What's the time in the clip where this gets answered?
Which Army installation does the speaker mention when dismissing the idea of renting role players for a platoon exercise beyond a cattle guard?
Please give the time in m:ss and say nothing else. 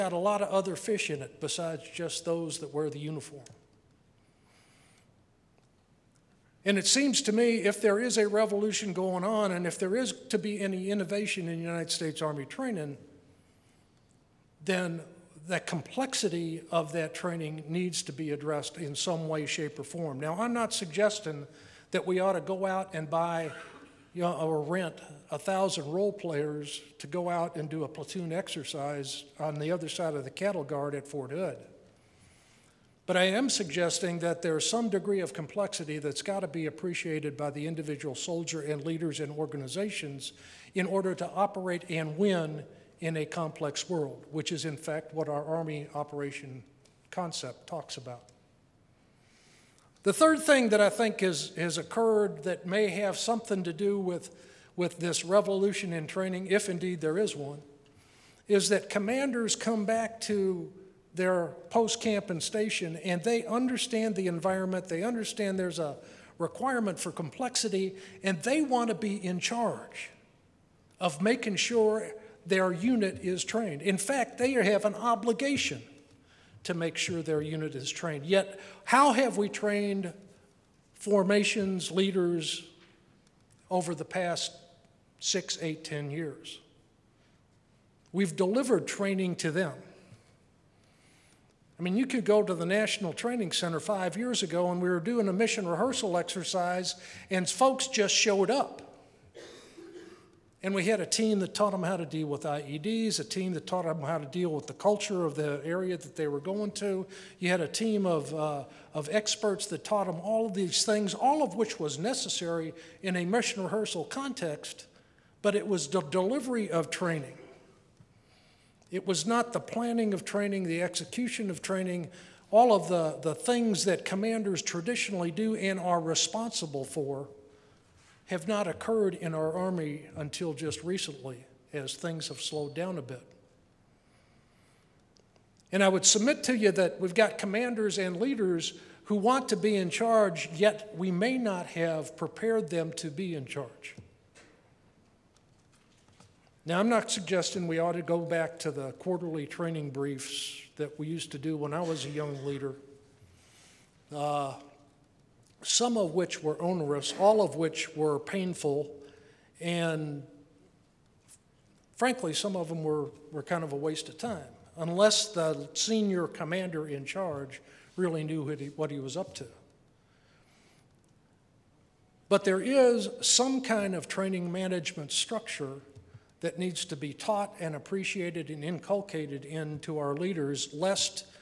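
0:31.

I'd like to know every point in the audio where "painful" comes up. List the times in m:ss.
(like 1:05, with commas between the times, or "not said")
2:38.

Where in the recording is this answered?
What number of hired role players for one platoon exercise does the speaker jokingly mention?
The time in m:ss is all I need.
0:25.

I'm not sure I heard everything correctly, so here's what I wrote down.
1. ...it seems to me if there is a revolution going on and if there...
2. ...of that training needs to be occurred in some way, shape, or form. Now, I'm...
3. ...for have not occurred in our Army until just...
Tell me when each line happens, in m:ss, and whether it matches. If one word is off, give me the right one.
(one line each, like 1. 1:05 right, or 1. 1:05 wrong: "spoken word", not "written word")
1. 0:06 right
2. 0:16 wrong: "addressed", not "occurred"
3. 2:06 right.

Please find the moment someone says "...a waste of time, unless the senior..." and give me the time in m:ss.
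2:43.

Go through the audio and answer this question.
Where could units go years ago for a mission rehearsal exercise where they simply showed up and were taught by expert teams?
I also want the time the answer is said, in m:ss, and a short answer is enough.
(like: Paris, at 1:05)
National Training Center, at 1:32.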